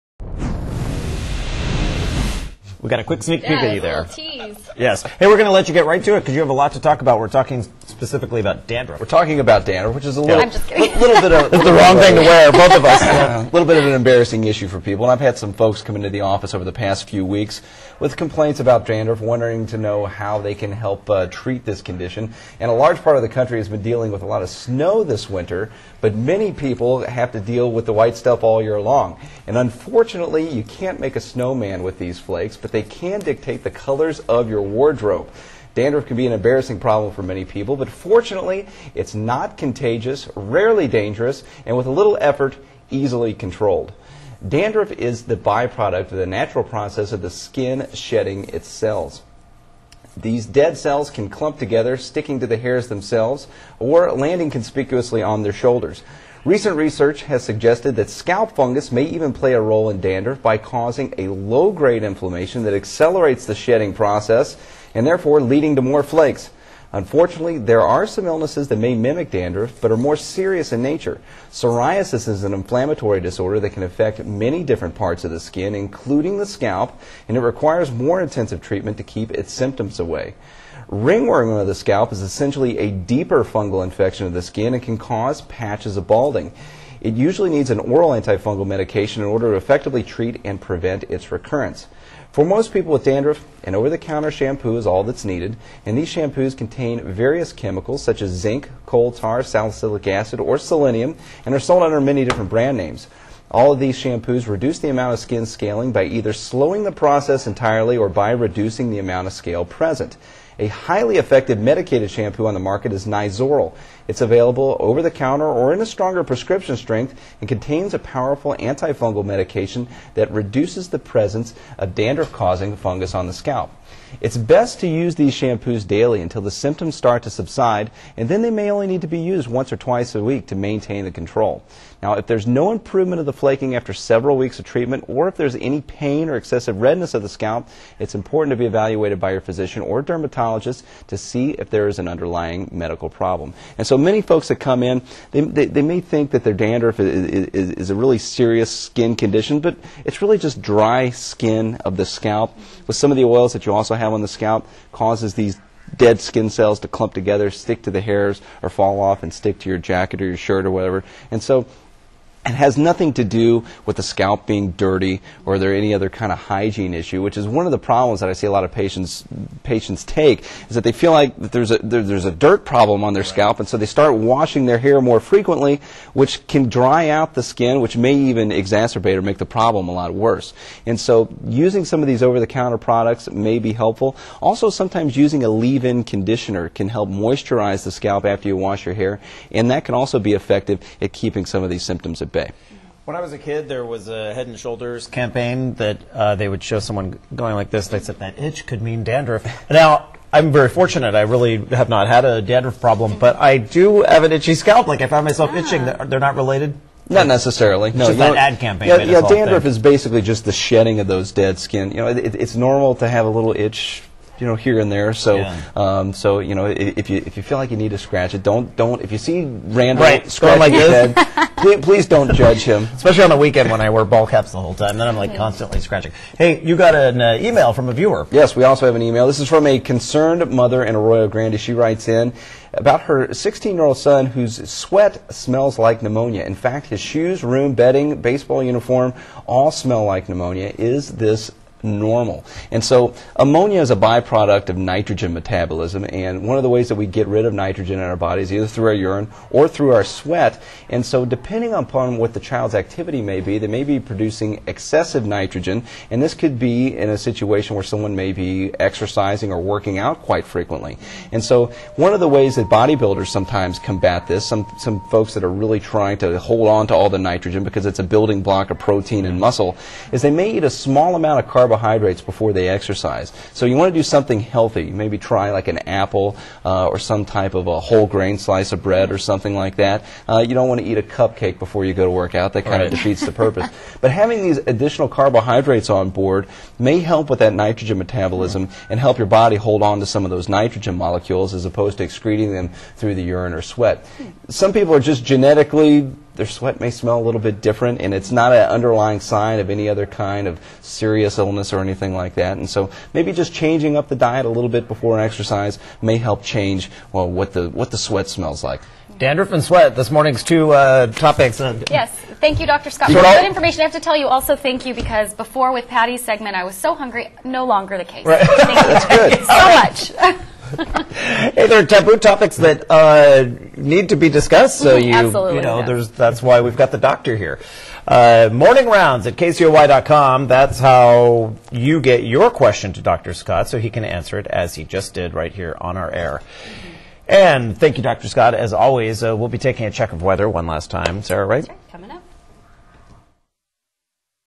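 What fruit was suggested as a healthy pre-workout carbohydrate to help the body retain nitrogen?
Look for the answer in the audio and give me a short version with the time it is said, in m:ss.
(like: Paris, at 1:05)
An apple, at 4:35.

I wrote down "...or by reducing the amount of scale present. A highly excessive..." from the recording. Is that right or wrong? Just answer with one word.
wrong.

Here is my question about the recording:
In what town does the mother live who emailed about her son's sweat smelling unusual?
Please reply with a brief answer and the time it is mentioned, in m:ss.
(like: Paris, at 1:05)
Arroyo Grande, at 3:50.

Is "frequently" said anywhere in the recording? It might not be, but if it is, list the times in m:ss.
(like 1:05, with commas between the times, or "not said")
2:55, 4:20.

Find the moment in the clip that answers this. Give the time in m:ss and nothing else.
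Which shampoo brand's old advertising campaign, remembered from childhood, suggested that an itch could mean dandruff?
3:14.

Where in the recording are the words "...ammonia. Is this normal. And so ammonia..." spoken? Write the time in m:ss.
4:00.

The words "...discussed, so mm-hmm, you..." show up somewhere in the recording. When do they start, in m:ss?
5:24.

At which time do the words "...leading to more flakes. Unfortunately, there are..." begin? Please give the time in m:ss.
1:05.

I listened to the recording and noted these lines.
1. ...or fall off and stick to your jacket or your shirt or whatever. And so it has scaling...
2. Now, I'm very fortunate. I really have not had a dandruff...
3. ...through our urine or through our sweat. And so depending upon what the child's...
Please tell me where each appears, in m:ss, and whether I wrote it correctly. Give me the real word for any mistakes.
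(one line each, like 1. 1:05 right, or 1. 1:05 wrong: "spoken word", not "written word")
1. 2:38 wrong: "nothing", not "scaling"
2. 3:19 right
3. 4:08 right.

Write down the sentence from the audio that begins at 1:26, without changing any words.
It usually needs an oral antifungal medication in order to effectively treat and prevent its recurrence.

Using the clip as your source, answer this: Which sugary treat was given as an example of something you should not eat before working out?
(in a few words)
A cupcake.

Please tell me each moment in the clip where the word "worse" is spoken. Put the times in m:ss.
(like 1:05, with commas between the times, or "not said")
3:00.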